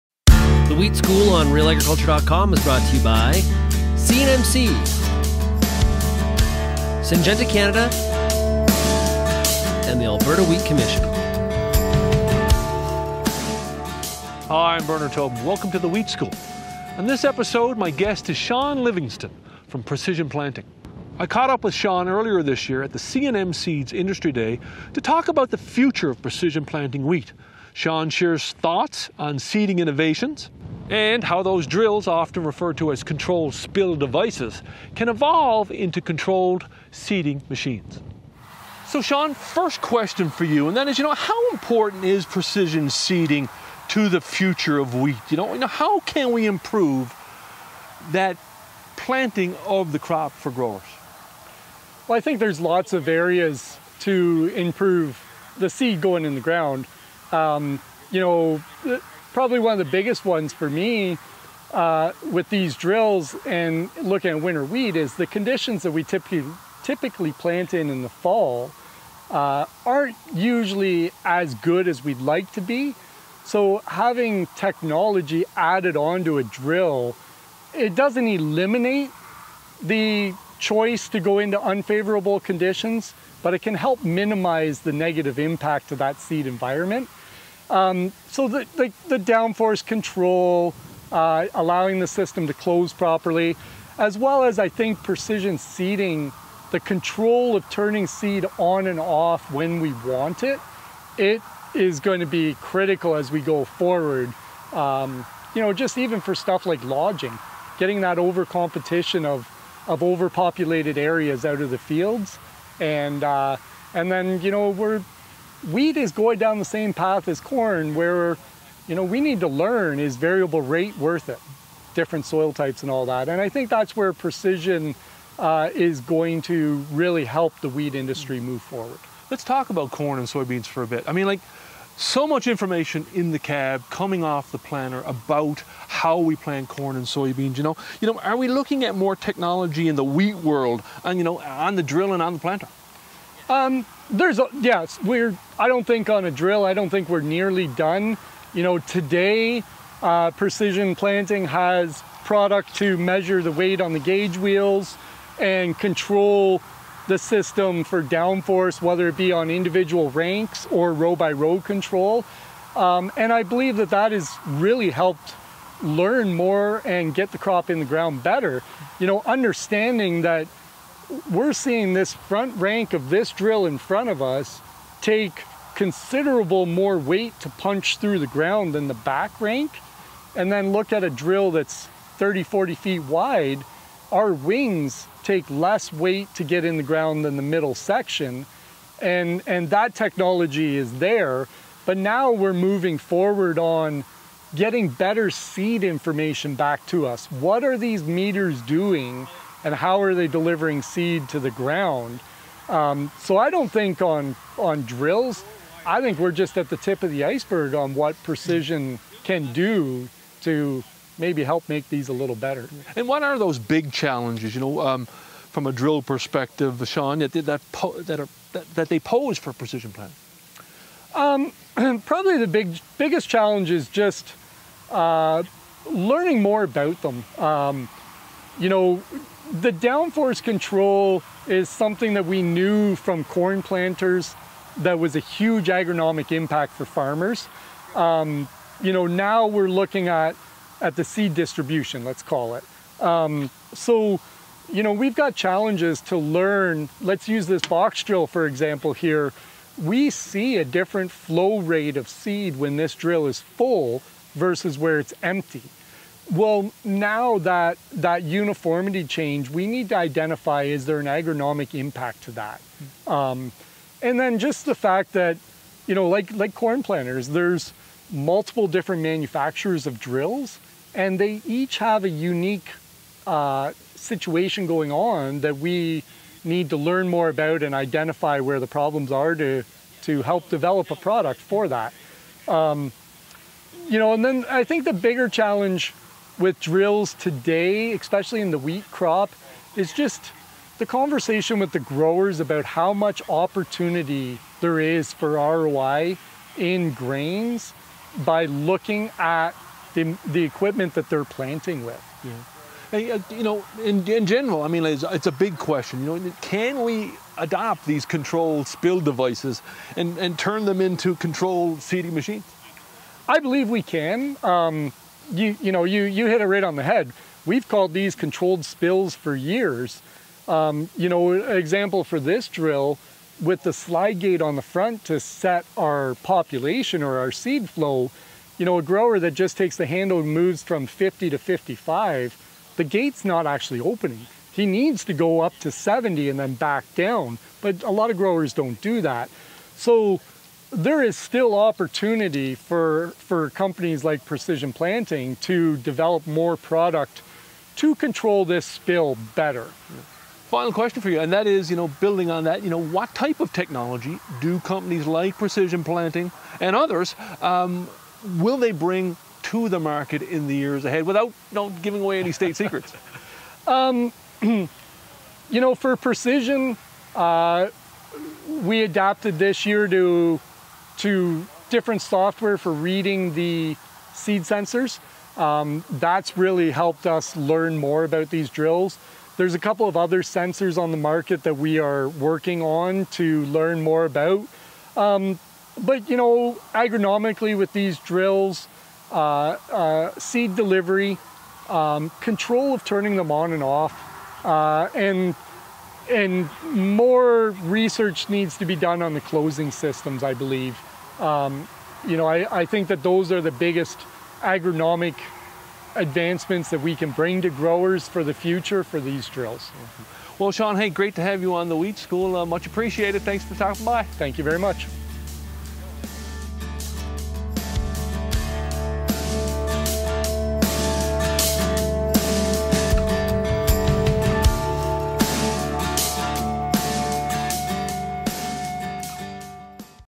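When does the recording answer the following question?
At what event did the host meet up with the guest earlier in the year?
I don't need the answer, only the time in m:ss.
0:22.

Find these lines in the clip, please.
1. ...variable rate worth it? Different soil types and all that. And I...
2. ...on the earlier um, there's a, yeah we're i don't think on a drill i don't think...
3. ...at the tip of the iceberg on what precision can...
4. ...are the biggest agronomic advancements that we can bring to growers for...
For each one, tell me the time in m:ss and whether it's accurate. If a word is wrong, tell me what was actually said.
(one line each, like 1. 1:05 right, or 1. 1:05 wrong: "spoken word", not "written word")
1. 2:00 right
2. 2:22 wrong: "planter", not "earlier"
3. 3:26 right
4. 6:43 right.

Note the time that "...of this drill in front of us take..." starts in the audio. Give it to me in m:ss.
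2:52.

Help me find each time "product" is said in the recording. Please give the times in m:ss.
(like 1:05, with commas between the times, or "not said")
2:32, 4:40, 5:46.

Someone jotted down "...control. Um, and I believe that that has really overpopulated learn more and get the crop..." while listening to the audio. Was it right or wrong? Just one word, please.
wrong.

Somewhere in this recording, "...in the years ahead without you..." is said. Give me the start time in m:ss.
6:00.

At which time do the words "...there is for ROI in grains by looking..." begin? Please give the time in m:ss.
4:54.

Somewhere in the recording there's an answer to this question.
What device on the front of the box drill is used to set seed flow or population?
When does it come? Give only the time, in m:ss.
5:23.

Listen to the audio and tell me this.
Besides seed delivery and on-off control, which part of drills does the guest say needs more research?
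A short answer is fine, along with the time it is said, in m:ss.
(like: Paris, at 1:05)
Closing systems, at 6:39.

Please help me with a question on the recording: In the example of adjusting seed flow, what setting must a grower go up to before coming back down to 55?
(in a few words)
70.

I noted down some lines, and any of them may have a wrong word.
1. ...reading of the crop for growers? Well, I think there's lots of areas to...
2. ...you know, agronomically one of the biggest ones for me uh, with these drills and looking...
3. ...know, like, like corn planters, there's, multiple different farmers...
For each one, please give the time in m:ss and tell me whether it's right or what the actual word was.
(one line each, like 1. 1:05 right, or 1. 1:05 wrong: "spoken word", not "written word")
1. 0:48 wrong: "planting", not "reading"
2. 0:58 wrong: "probably", not "agronomically"
3. 4:25 wrong: "manufacturers", not "farmers".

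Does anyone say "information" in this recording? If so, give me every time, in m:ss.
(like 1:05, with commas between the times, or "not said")
2:12, 3:15.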